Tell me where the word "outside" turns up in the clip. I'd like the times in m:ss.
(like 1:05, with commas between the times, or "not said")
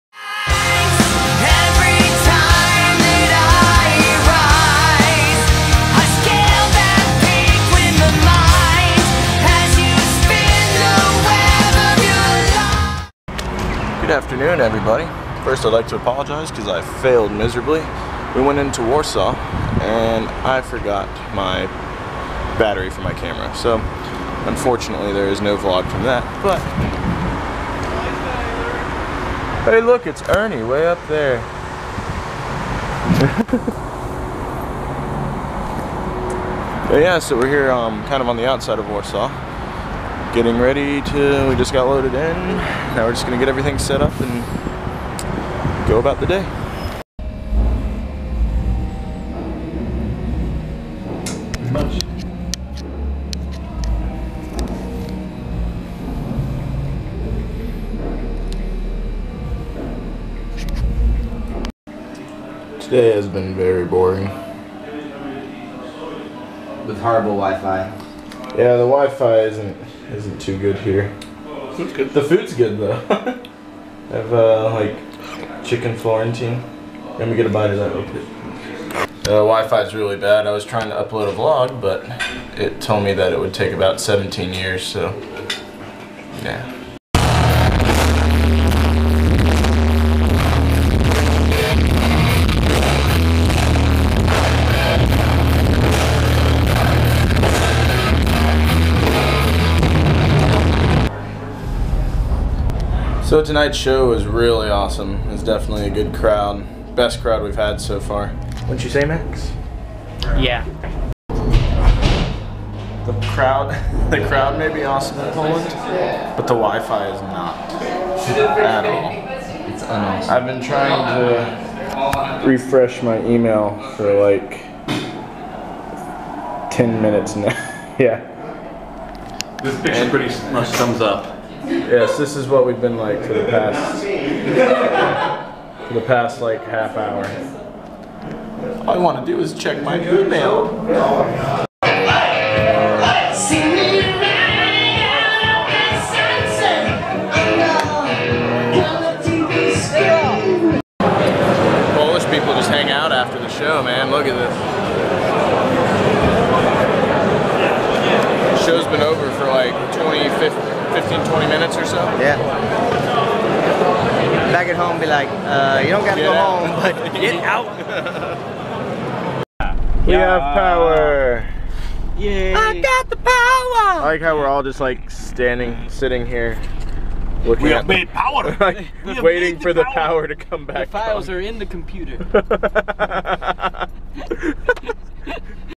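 0:38.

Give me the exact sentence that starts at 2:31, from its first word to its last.
Polish people just hang out after the show, man.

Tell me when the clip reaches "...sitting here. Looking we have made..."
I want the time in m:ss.
2:55.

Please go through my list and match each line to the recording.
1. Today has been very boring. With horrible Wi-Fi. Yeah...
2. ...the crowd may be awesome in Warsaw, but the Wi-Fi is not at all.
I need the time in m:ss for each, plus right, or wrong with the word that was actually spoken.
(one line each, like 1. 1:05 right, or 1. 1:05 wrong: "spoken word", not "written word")
1. 1:02 right
2. 1:54 wrong: "Poland", not "Warsaw".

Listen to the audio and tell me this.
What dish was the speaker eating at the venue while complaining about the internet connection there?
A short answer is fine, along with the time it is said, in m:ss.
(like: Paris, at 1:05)
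Chicken Florentine, at 1:15.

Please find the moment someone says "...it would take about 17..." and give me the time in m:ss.
1:23.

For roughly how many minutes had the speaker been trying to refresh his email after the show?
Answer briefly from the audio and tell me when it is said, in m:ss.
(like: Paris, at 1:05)
10, at 2:06.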